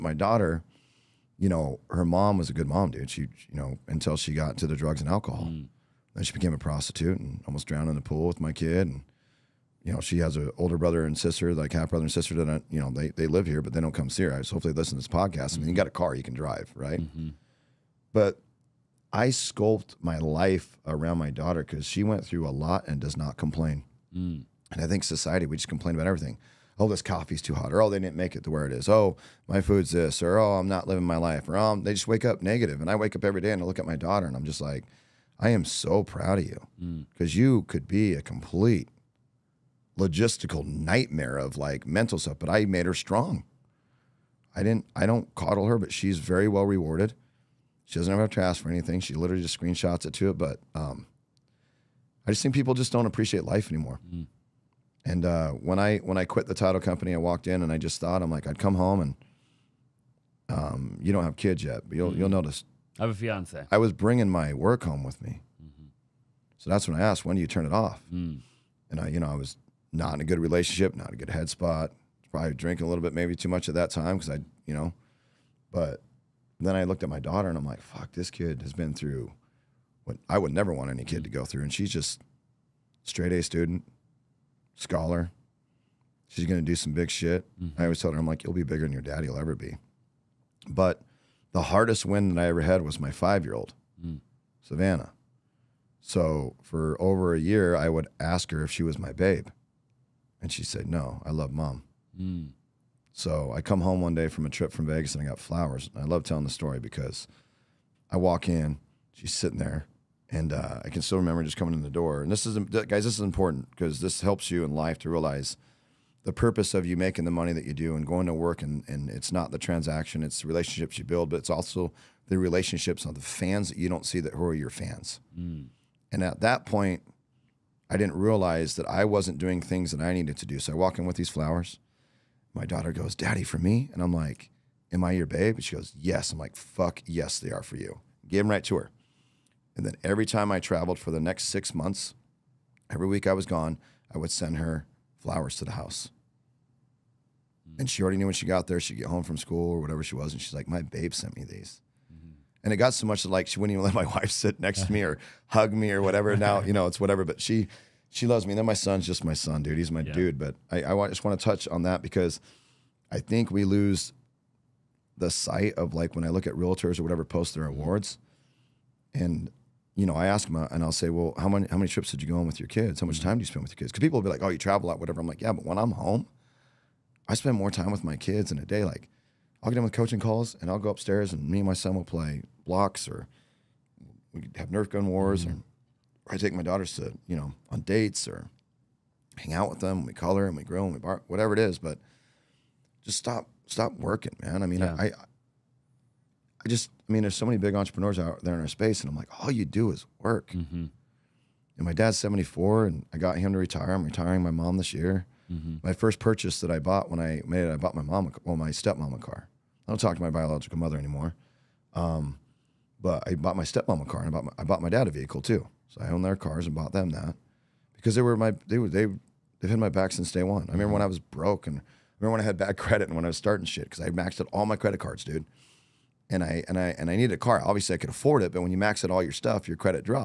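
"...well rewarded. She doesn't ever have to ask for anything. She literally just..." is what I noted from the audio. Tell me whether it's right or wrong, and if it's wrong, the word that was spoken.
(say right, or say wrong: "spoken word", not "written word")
right.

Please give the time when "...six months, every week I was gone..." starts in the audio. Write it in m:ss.
2:21.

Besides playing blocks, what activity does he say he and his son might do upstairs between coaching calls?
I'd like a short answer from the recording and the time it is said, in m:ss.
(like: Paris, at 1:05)
Nerf gun wars, at 3:04.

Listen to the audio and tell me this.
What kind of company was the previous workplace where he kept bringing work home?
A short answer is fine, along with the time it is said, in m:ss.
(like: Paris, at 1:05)
Title company, at 0:56.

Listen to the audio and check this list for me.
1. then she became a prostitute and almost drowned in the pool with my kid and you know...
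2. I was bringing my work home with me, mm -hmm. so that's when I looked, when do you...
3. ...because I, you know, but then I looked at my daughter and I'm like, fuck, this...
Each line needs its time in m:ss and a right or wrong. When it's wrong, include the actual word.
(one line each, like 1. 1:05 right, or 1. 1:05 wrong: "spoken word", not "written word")
1. 0:06 right
2. 1:03 wrong: "asked", not "looked"
3. 1:14 right.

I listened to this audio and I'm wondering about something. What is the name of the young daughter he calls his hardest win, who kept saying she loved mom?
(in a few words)
Savannah.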